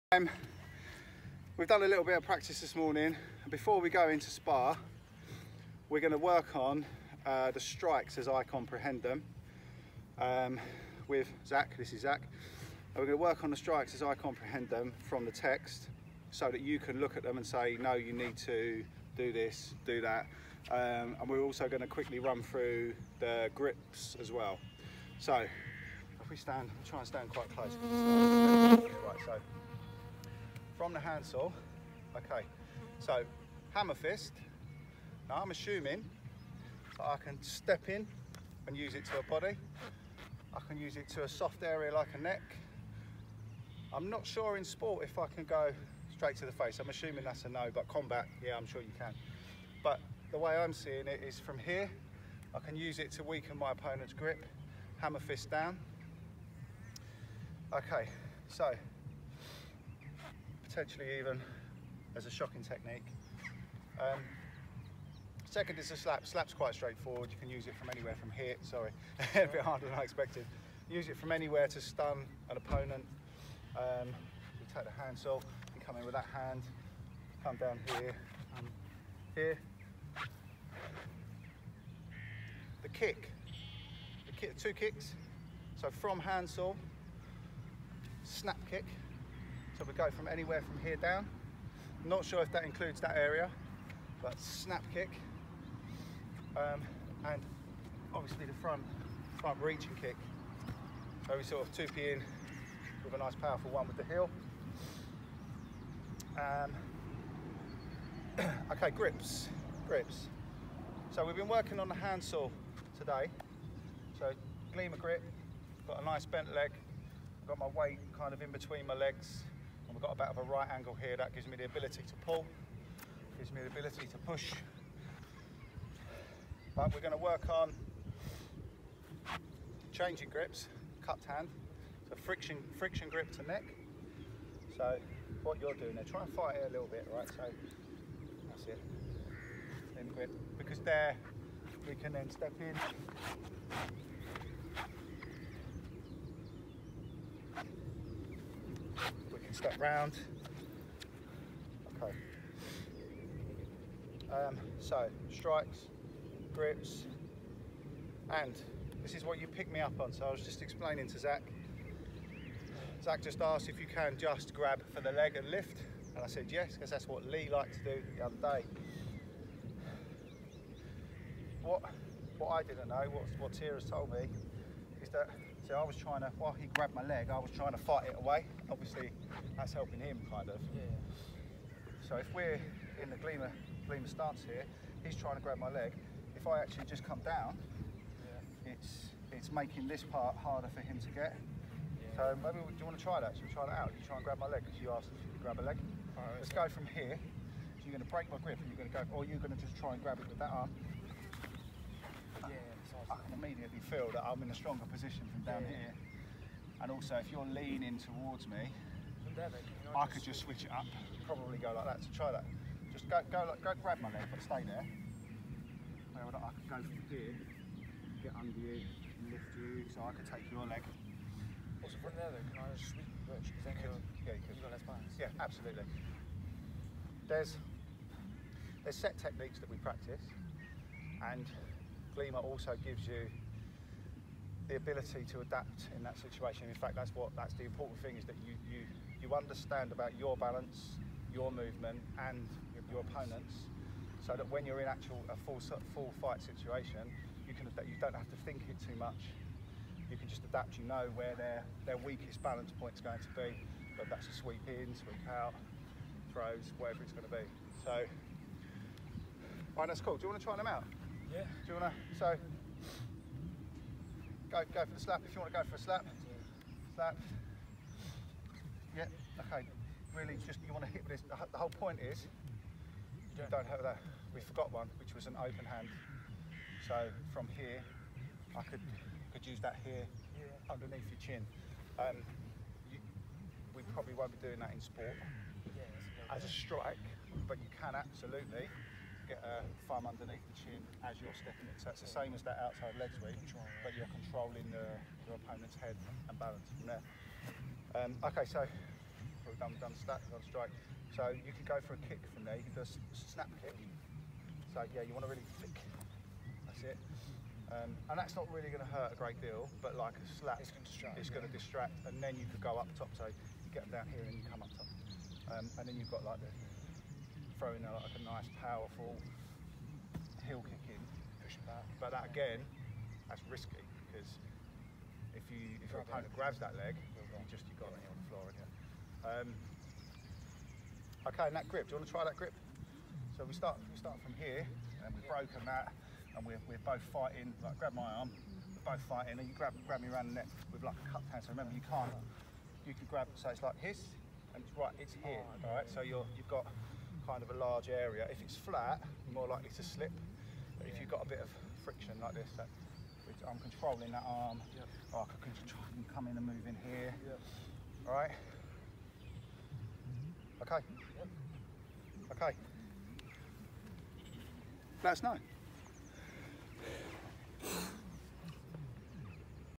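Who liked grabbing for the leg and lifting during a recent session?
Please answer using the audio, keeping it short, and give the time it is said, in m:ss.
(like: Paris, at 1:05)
Lee, at 2:47.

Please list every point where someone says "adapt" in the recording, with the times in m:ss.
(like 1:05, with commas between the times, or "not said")
3:55, 4:10.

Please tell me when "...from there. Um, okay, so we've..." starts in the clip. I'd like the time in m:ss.
4:56.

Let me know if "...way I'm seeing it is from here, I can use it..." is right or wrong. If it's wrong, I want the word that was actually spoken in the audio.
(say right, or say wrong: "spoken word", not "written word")
right.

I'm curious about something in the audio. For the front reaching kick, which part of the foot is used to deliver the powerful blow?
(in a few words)
The heel.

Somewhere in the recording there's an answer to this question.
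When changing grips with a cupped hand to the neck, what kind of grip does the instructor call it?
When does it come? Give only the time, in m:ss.
2:12.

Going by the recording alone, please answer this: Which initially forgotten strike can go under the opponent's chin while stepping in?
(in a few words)
Open hand.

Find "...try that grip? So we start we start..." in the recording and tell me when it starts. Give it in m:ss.
5:32.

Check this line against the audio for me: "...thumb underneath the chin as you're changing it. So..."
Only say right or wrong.
wrong.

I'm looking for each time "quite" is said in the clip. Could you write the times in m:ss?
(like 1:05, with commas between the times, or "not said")
0:27, 1:06.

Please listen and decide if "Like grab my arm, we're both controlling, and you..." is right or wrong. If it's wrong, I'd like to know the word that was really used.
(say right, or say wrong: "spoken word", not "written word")
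wrong: "fighting", not "controlling".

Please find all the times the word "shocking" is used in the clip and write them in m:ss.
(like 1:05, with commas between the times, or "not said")
1:02.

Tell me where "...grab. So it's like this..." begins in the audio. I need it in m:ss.
5:43.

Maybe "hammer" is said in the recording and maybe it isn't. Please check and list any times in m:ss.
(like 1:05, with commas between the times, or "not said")
0:33, 0:54.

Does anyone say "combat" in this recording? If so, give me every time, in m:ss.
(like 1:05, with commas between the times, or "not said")
0:47.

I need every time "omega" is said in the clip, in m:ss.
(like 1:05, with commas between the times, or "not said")
not said.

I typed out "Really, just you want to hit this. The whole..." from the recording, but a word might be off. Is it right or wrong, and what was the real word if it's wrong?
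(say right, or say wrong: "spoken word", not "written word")
right.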